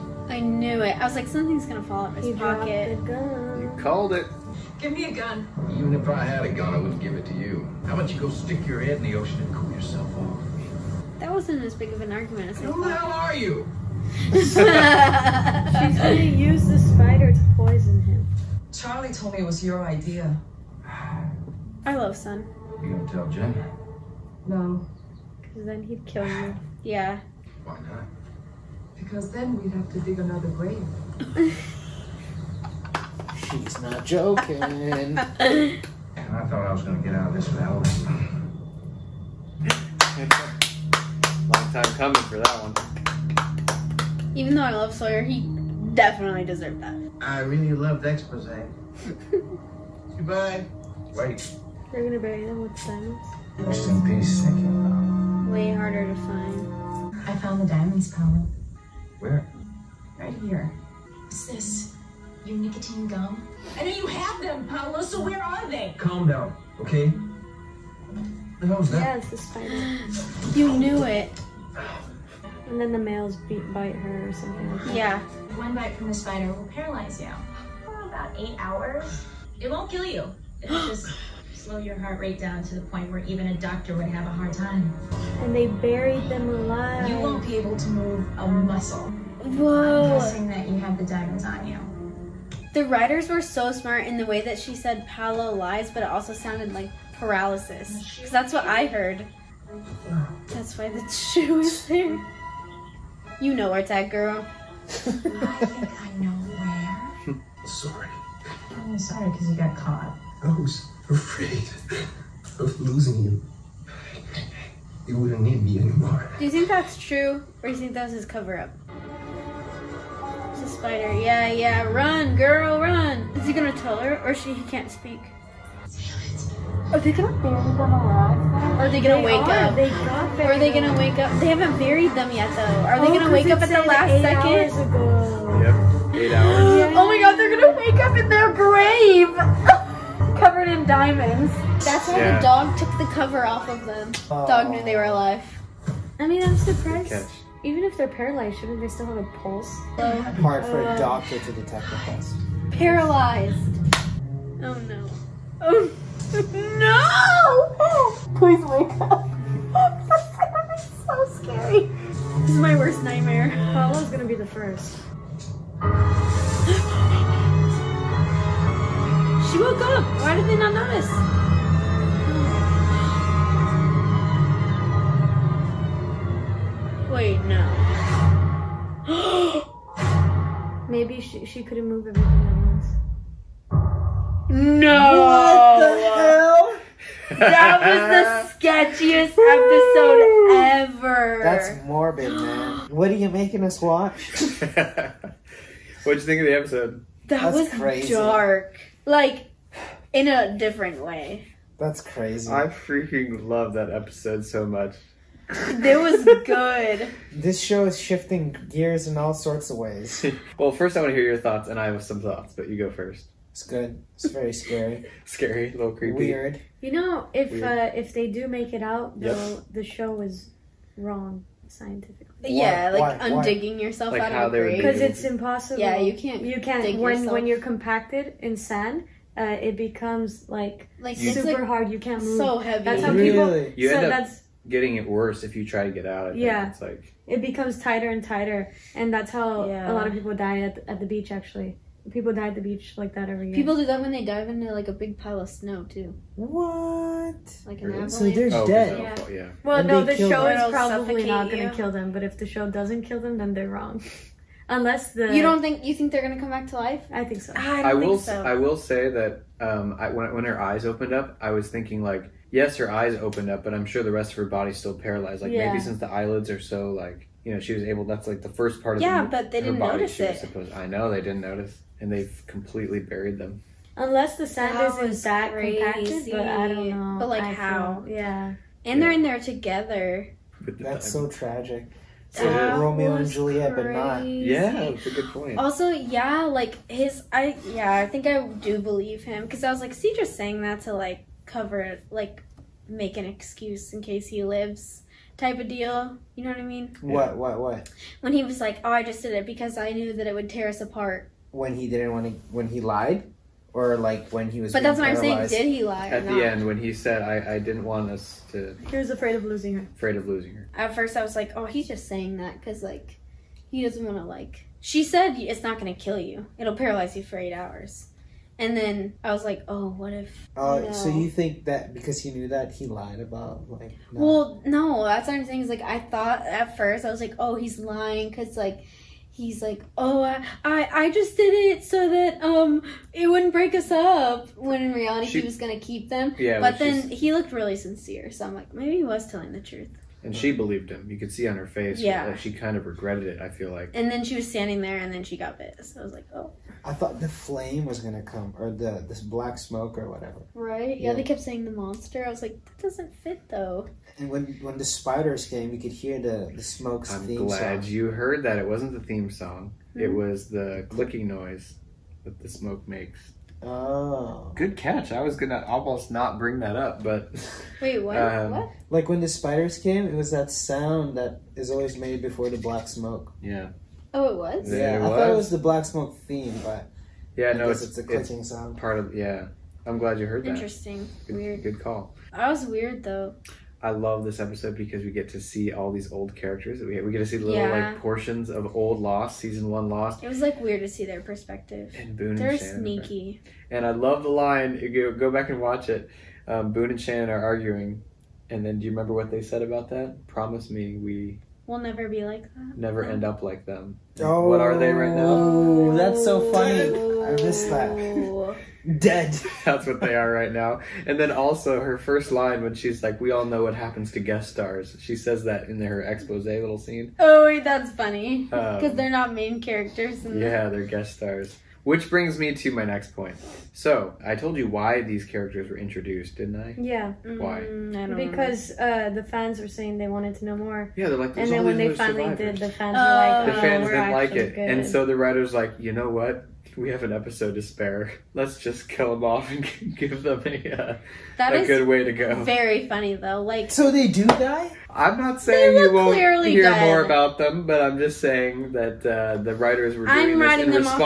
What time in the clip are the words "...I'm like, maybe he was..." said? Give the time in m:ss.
5:38.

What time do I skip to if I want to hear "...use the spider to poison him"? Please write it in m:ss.
0:16.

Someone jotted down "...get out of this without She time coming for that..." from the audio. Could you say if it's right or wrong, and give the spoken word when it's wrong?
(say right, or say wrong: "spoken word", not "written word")
wrong: "Long", not "She".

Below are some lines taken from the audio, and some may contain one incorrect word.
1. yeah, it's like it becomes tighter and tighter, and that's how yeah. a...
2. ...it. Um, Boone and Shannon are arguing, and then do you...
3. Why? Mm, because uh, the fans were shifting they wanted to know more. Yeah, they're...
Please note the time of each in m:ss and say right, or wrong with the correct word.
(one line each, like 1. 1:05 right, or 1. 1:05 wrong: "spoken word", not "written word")
1. 3:56 right
2. 6:35 right
3. 7:07 wrong: "saying", not "shifting".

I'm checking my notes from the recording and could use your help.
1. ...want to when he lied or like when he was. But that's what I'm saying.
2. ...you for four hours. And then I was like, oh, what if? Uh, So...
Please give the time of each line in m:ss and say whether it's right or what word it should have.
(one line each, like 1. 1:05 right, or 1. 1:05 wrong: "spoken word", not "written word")
1. 5:02 right
2. 5:17 wrong: "eight", not "four".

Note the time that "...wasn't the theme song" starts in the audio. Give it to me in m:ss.
5:58.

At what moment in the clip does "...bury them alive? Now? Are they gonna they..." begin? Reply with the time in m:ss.
2:07.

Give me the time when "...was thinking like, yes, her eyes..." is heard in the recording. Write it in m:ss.
4:21.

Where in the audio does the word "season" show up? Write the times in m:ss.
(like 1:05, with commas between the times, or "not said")
6:29.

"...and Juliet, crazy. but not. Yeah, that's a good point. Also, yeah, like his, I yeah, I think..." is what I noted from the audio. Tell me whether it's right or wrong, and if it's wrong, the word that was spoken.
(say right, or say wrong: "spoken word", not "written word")
right.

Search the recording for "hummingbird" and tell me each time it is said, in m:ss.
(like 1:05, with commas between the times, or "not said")
not said.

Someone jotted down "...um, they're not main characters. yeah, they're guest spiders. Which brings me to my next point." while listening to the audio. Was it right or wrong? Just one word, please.
wrong.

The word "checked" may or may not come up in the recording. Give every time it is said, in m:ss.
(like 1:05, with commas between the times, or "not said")
not said.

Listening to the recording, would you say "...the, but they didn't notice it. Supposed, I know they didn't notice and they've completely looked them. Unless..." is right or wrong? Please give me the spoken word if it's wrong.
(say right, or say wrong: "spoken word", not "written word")
wrong: "buried", not "looked".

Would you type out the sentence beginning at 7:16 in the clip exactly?
we have an episode to spare.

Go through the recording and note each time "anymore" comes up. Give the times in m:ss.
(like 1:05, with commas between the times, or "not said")
1:55.